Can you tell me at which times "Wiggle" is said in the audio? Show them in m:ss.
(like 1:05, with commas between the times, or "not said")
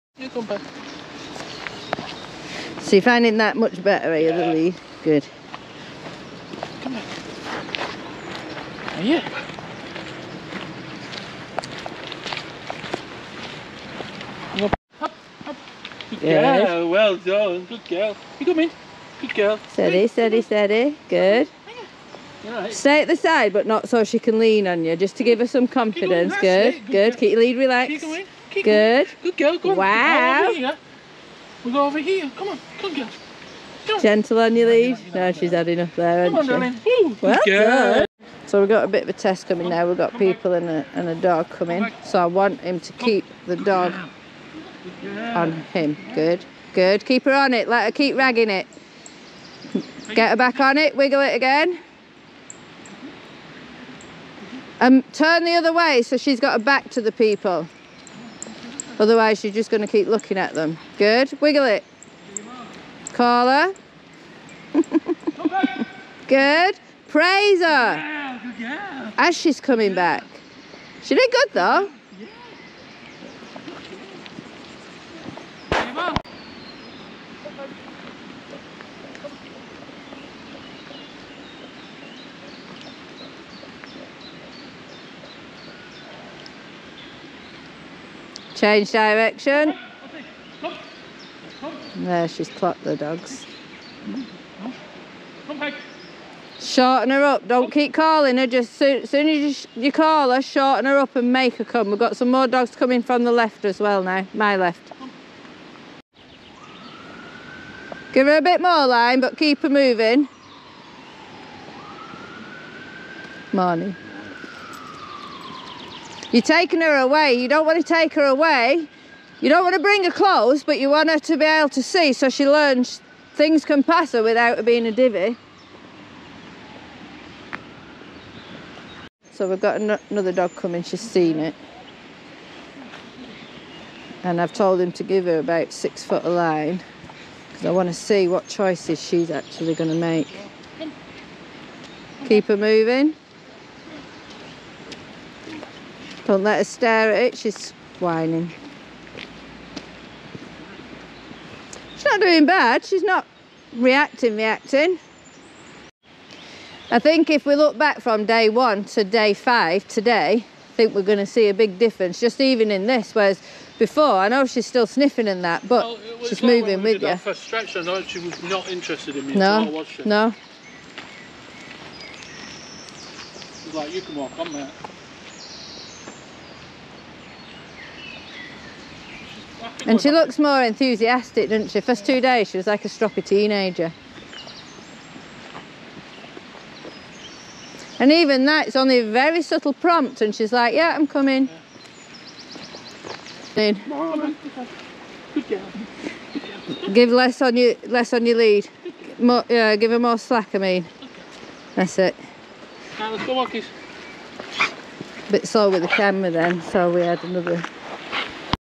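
0:50, 1:01.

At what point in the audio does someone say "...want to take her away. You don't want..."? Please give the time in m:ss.
1:57.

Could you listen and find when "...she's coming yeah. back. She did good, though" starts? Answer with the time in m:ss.
1:09.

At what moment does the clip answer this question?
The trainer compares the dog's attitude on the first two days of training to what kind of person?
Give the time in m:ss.
3:02.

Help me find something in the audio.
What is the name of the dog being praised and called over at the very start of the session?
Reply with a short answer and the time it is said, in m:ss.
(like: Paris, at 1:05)
Lily, at 0:04.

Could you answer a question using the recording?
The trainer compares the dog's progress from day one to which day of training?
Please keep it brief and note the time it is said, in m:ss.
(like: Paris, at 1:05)
Day 5, at 2:39.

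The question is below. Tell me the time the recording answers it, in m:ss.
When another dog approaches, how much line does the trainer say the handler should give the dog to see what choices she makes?
2:15.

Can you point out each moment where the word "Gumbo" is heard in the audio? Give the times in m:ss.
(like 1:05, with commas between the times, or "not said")
0:00.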